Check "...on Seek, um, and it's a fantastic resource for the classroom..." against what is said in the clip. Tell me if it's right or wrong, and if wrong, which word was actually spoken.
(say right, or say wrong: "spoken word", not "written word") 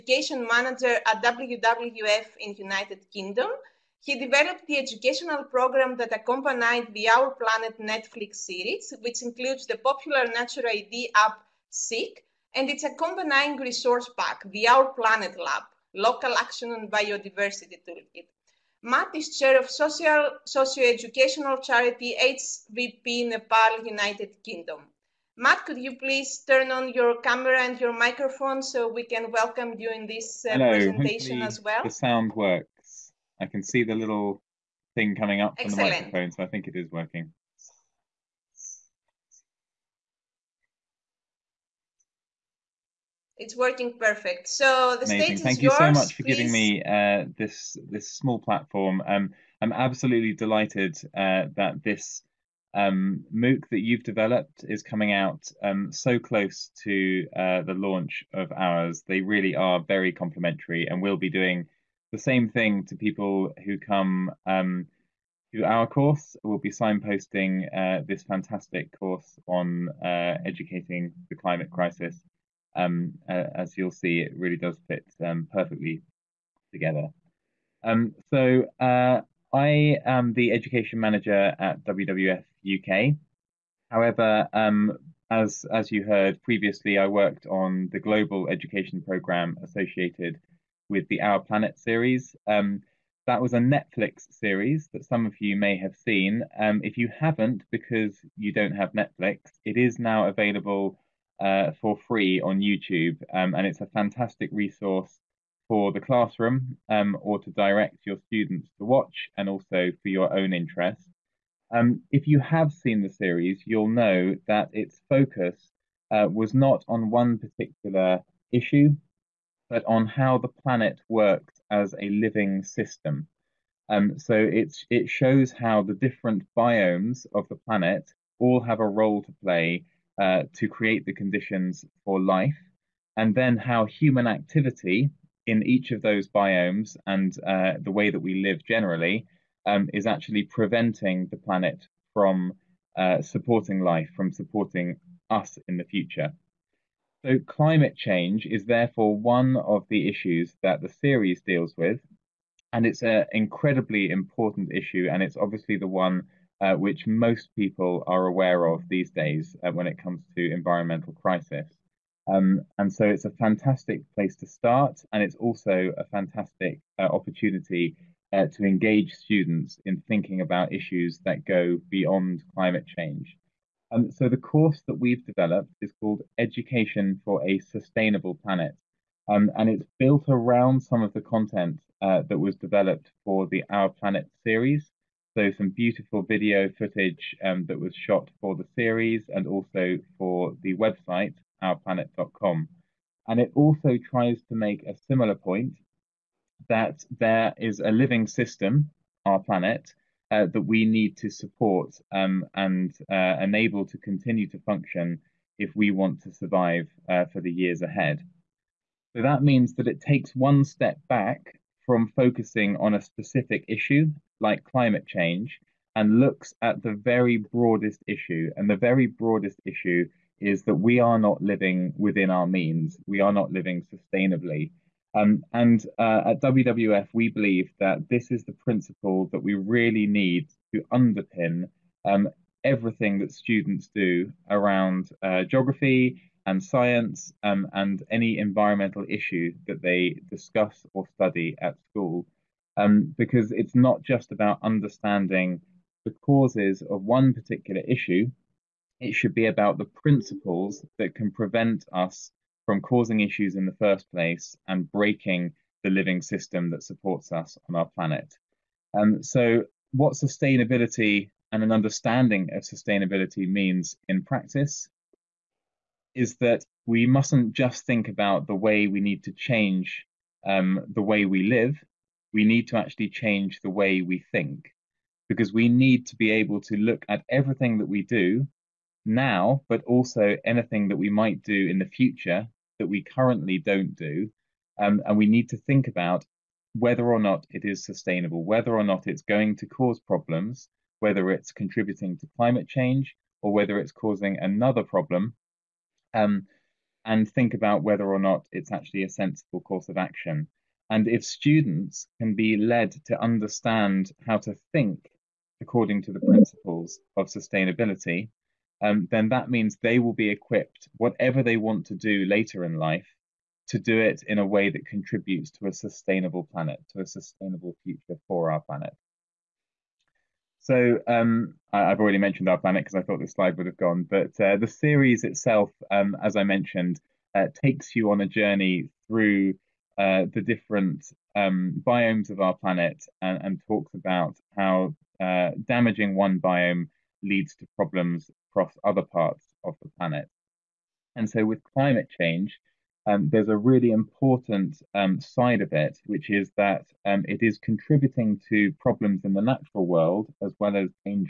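wrong: "YouTube", not "Seek".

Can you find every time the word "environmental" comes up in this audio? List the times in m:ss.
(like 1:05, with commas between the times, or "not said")
2:40, 3:58.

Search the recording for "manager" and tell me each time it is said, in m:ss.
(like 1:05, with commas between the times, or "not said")
0:00, 1:20.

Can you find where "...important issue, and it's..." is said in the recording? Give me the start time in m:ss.
2:34.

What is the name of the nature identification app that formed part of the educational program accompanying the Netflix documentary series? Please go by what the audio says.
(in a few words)
Seek.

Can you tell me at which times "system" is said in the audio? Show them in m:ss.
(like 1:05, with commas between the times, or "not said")
2:02, 3:18, 4:16.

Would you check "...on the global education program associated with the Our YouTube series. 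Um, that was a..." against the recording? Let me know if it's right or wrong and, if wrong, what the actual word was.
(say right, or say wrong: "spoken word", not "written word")
wrong: "Planet", not "YouTube".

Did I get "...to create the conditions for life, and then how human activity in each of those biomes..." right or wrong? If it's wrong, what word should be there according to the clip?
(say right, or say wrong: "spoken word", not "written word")
right.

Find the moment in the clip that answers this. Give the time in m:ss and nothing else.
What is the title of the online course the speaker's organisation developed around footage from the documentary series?
2:56.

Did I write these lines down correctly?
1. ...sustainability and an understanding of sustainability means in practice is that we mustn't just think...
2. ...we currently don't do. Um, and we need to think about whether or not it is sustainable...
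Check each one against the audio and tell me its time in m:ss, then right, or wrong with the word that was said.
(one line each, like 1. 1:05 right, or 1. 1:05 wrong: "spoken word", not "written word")
1. 4:20 right
2. 4:42 right.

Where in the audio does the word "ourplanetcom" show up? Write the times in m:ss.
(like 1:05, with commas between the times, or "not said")
3:11.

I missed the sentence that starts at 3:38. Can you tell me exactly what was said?
And the very broadest issue is that we are not living within our means, we are not living sustainably.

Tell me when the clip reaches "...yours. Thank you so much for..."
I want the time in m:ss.
0:45.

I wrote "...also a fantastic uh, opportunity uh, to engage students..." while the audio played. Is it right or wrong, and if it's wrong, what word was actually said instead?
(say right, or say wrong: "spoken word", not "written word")
right.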